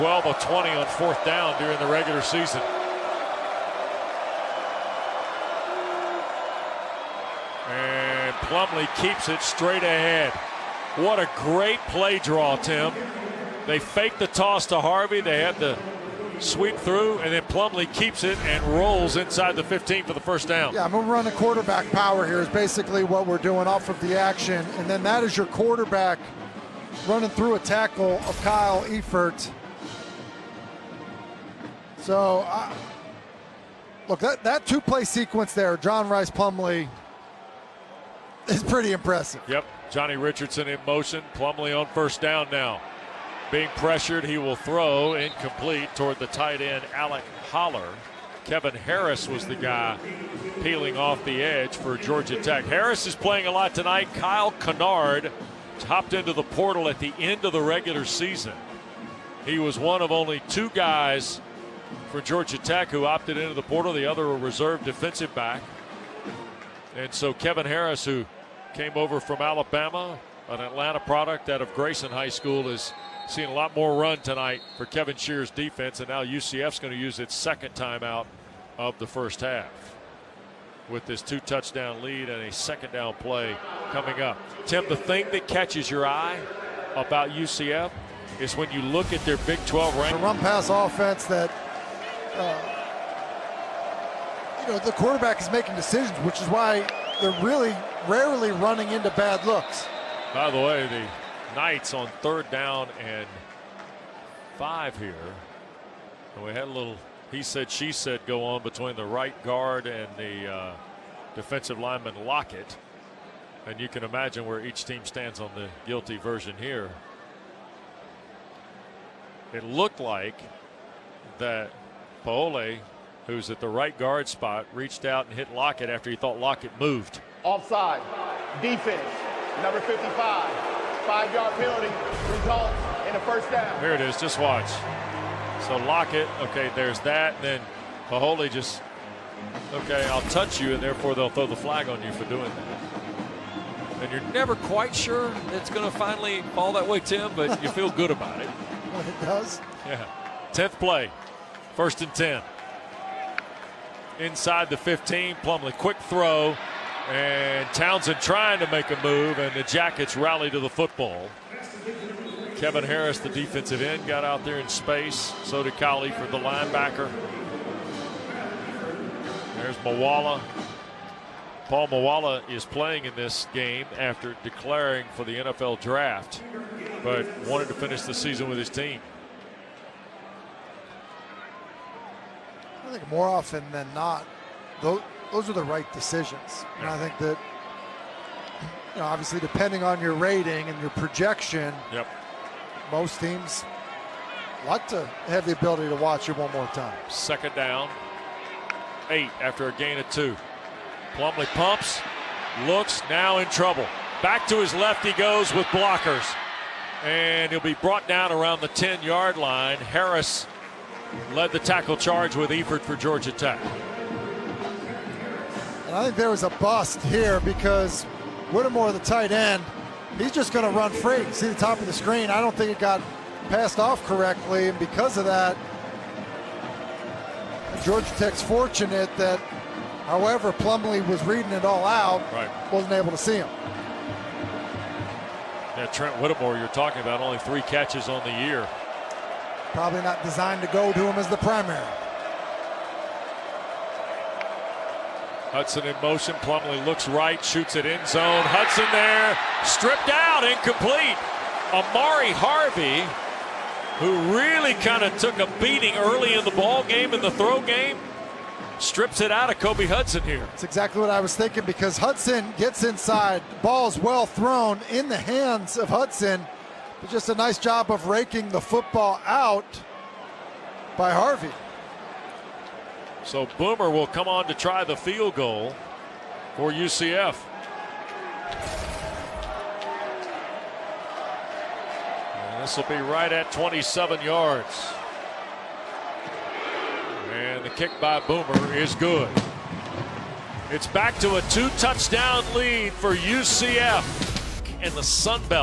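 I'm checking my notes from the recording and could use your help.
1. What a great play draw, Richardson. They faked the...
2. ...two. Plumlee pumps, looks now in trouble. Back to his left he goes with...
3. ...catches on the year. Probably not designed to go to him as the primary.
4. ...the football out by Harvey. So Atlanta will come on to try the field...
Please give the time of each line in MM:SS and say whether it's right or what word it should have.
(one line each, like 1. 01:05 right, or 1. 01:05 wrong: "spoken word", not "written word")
1. 00:10 wrong: "Tim", not "Richardson"
2. 03:20 right
3. 03:57 right
4. 04:28 wrong: "Boomer", not "Atlanta".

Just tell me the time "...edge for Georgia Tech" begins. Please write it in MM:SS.
00:51.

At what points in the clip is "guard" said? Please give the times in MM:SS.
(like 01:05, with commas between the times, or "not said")
01:49, 02:03.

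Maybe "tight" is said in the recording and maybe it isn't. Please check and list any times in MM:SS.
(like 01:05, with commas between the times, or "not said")
00:46, 03:38.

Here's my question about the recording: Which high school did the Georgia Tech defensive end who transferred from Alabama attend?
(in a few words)
Grayson High School.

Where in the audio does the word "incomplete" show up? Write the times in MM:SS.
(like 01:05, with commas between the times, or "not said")
00:45, 04:10.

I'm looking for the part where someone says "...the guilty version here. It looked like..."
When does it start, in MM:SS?
01:55.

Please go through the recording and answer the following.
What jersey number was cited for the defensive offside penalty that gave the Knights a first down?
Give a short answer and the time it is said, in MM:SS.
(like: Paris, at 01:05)
55, at 02:09.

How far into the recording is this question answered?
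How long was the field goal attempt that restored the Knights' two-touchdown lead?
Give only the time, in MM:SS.
04:43.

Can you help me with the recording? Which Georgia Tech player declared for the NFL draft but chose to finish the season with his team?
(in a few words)
Paul Moala.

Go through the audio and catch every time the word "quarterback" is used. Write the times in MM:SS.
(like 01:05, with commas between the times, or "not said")
00:21, 00:25, 01:34.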